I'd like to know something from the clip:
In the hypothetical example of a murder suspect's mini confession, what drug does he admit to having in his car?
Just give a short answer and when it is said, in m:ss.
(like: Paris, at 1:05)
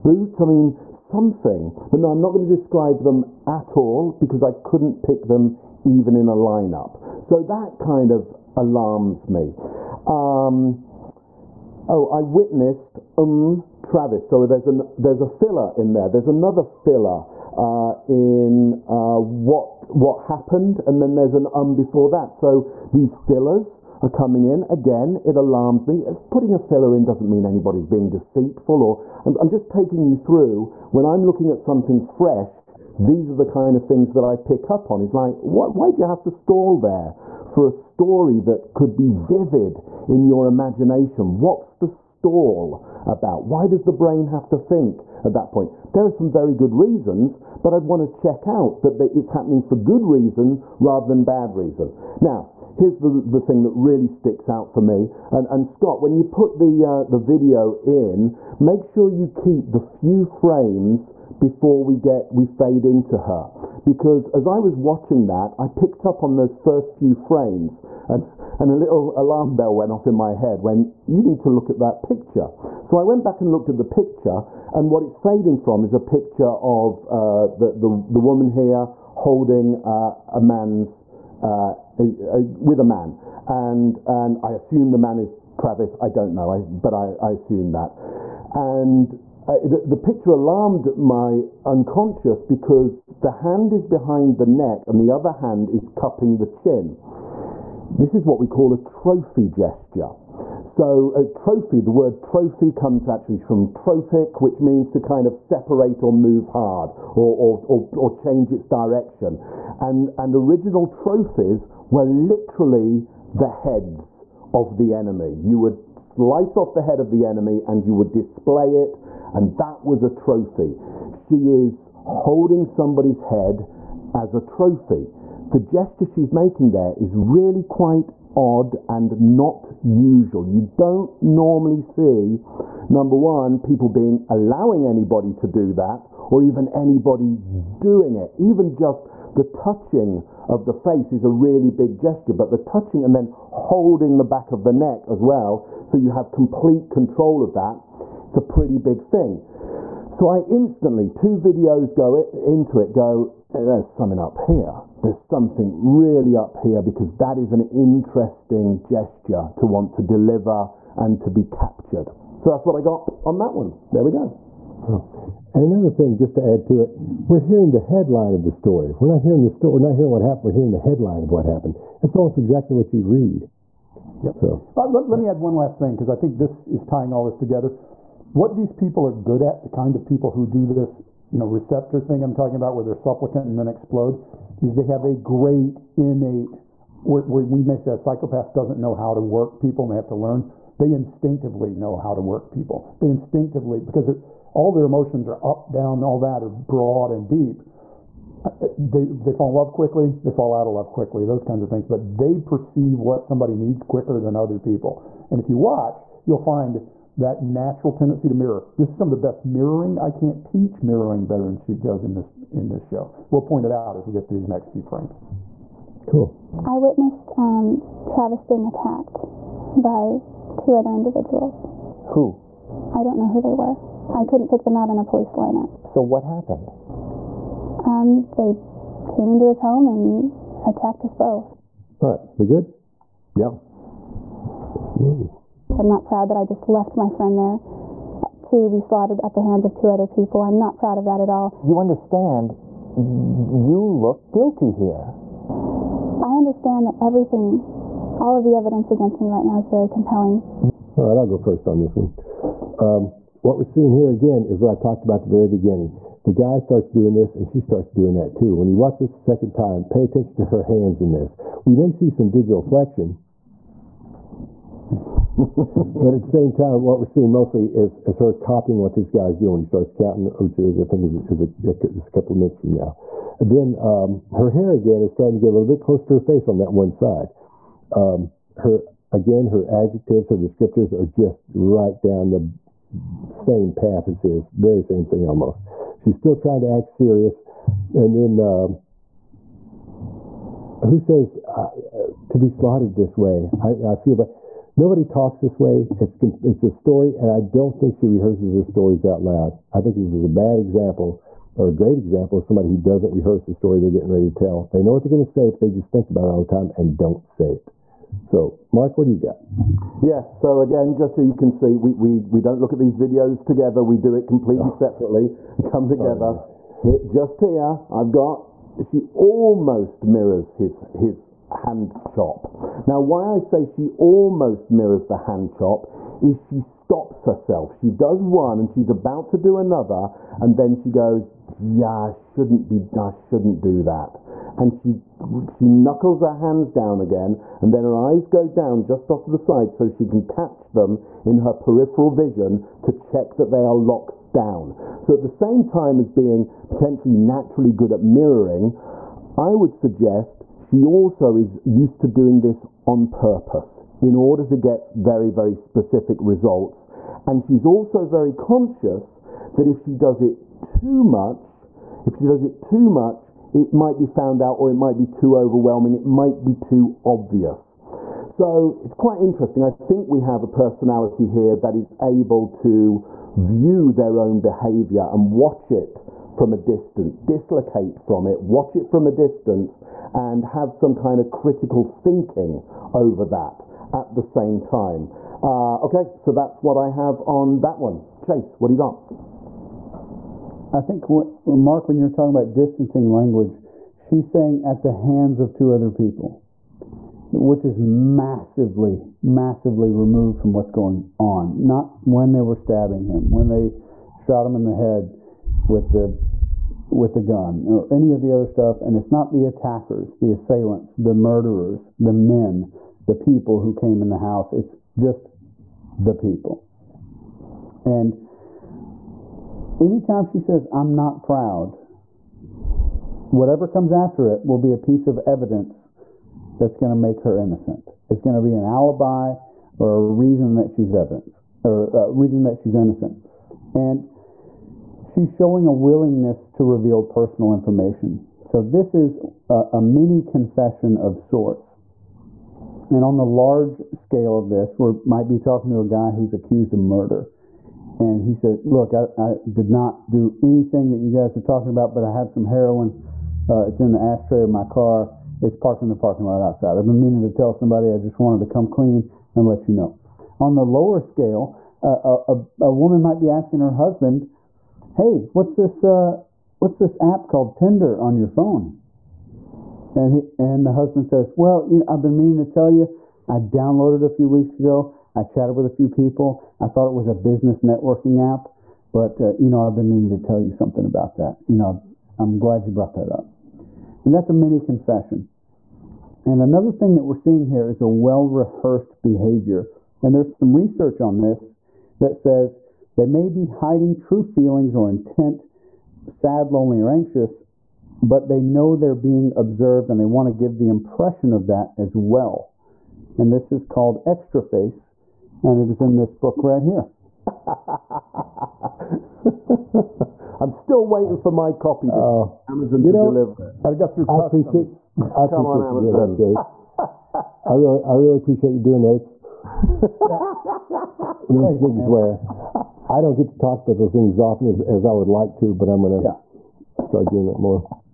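heroin, at 7:32.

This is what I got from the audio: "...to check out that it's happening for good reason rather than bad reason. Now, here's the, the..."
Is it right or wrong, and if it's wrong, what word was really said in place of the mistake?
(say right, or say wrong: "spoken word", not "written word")
right.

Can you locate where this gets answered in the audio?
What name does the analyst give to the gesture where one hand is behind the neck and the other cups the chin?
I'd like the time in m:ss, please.
1:38.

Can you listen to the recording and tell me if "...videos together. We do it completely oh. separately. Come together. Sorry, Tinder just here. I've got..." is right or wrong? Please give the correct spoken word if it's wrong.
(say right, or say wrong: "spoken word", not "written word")
wrong: "Hit", not "Tinder".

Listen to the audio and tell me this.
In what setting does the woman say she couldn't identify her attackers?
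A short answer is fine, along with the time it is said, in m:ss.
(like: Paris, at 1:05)
police lineup, at 3:45.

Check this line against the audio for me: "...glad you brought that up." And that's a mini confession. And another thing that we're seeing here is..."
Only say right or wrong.
right.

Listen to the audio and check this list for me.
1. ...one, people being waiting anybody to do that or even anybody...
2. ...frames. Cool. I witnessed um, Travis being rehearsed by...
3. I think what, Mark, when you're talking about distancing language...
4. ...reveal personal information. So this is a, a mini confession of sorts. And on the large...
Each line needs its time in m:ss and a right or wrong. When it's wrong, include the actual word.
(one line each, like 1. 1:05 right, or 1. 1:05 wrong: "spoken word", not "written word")
1. 2:13 wrong: "allowing", not "waiting"
2. 3:34 wrong: "attacked", not "rehearsed"
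3. 6:30 right
4. 7:16 right.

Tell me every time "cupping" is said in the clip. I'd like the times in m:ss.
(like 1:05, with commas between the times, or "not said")
1:35.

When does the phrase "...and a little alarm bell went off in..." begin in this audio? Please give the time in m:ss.
1:08.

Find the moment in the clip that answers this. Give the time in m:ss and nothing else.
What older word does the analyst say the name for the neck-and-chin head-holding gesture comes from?
1:43.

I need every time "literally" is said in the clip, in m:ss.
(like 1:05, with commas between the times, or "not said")
1:52.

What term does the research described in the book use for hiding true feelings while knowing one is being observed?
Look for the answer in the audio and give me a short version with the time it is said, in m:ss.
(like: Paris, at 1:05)
extra face, at 8:24.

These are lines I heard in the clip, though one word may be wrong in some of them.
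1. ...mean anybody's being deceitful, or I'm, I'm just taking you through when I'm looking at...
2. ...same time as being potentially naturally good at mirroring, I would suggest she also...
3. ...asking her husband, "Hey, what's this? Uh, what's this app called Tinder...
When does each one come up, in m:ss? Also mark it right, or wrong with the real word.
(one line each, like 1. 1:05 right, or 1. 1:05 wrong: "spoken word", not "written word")
1. 0:27 right
2. 5:45 right
3. 7:43 right.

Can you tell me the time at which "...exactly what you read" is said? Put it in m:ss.
2:52.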